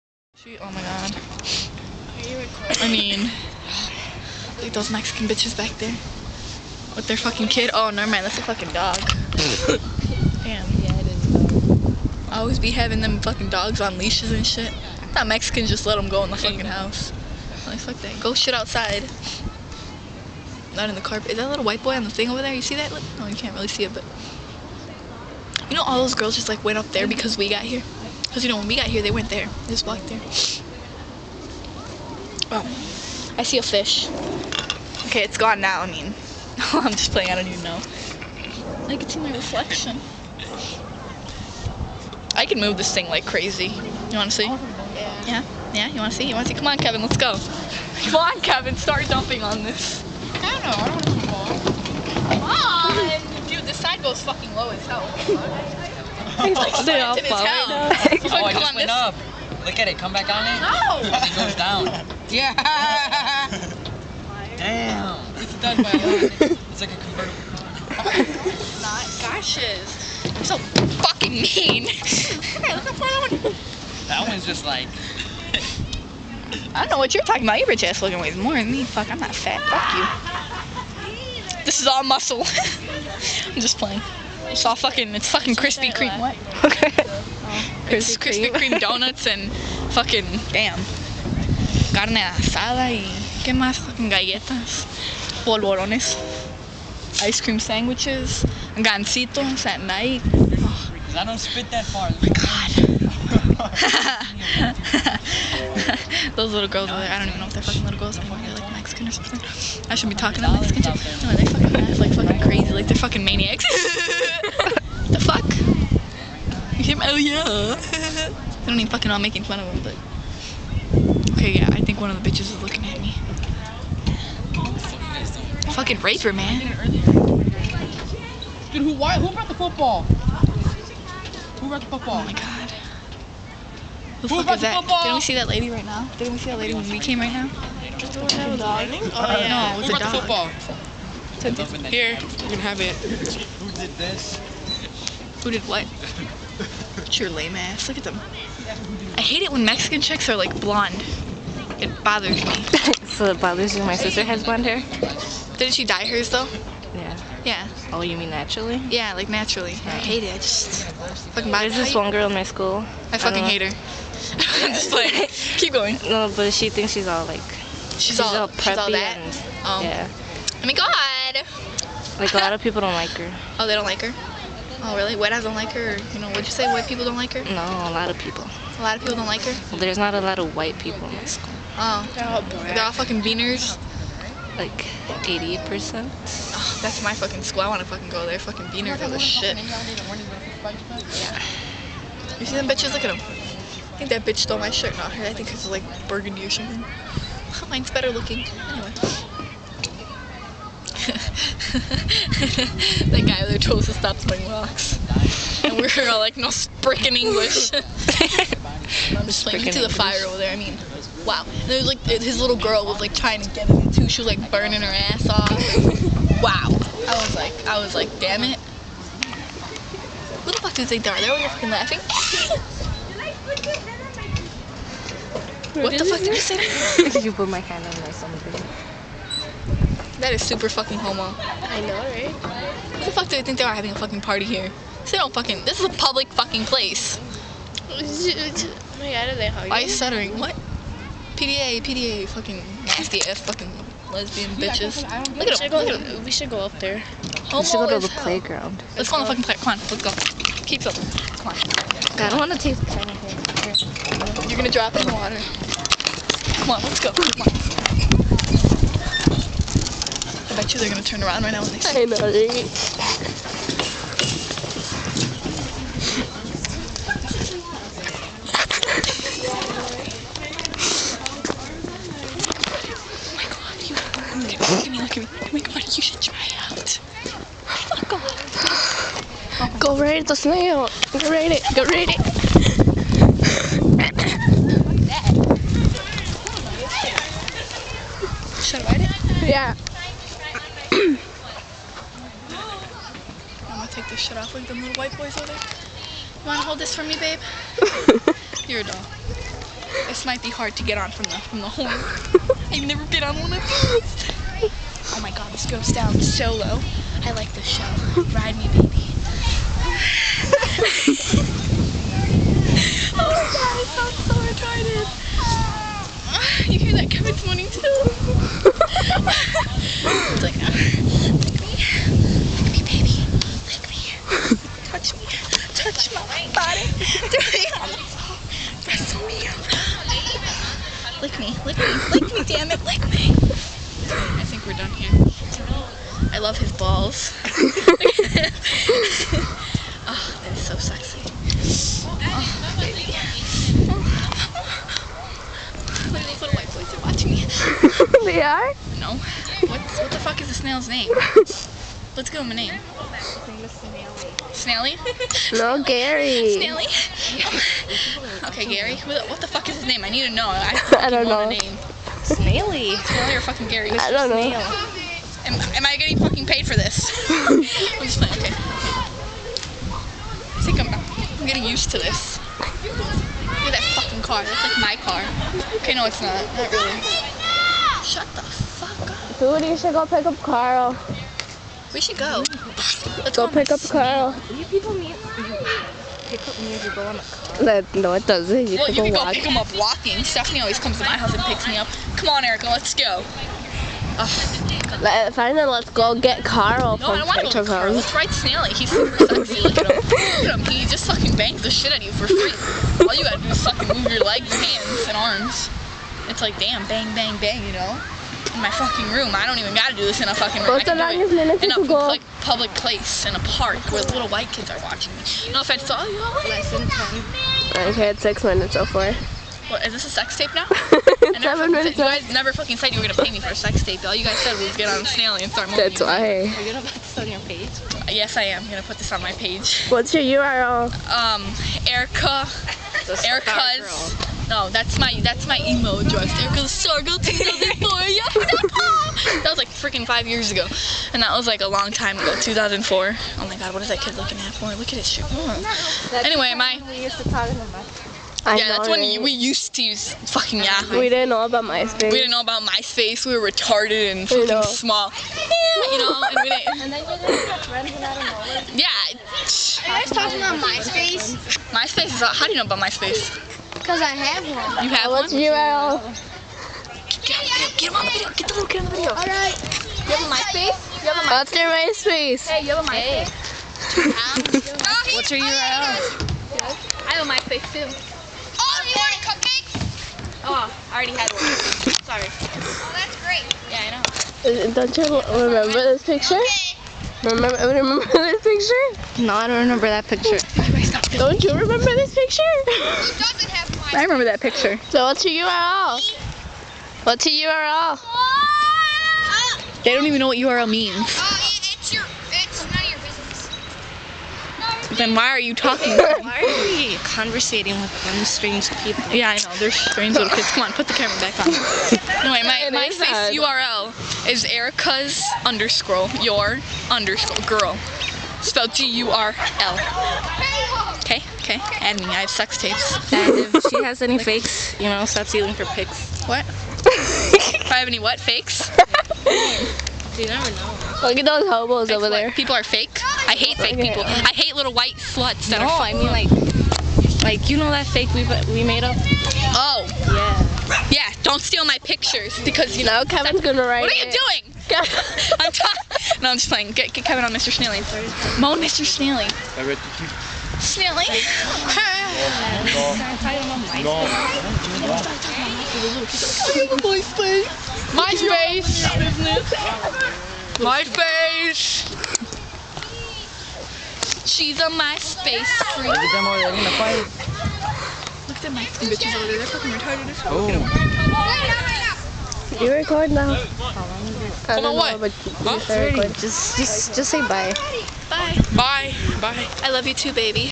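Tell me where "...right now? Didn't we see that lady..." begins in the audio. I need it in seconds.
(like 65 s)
135 s.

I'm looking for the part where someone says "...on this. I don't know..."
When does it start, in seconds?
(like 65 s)
49 s.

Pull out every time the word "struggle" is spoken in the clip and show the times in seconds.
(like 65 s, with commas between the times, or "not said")
436 s.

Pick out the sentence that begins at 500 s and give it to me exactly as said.
Oh, it's your, it's then why are you talking?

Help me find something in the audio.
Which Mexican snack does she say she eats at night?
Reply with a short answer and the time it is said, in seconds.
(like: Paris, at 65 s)
gansitos, at 98 s.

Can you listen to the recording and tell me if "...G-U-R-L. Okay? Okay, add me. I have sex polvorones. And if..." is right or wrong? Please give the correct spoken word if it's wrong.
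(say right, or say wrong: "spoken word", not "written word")
wrong: "tapes", not "polvorones".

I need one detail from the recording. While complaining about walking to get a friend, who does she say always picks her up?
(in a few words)
Stephanie.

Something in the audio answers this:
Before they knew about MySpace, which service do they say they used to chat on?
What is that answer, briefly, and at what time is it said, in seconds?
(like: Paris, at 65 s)
Yahoo, at 450 s.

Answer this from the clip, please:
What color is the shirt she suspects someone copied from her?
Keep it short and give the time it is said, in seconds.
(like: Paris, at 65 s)
burgundy, at 196 s.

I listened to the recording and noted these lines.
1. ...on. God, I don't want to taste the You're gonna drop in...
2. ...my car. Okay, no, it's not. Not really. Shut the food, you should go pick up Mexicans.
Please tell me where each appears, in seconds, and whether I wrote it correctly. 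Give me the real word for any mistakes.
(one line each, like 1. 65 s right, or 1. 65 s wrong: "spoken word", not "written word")
1. 251 s right
2. 374 s wrong: "Carl", not "Mexicans".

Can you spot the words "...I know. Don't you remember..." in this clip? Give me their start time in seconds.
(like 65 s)
483 s.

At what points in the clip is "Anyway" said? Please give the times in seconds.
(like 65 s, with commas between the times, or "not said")
198 s, 446 s.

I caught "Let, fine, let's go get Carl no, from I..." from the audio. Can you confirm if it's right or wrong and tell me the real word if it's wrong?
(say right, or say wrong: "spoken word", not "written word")
right.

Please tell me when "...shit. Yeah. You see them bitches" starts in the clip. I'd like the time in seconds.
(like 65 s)
189 s.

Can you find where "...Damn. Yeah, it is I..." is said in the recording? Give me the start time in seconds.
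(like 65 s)
10 s.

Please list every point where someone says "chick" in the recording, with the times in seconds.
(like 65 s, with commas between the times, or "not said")
110 s, 150 s.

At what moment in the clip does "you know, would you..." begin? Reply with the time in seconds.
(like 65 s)
176 s.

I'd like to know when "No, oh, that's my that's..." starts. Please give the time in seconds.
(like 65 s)
434 s.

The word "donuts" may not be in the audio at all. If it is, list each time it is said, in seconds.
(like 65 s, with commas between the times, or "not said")
88 s.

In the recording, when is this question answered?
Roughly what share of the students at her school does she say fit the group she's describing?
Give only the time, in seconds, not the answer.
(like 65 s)
185 s.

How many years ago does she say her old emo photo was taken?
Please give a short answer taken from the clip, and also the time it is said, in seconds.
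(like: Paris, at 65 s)
5, at 440 s.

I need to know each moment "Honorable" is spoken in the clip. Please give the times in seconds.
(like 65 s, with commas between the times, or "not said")
not said.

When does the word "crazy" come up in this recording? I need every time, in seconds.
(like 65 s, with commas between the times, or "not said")
43 s, 112 s.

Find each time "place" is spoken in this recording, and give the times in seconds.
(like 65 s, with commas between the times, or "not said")
236 s, 412 s.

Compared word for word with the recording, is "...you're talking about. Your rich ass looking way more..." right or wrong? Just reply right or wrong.
right.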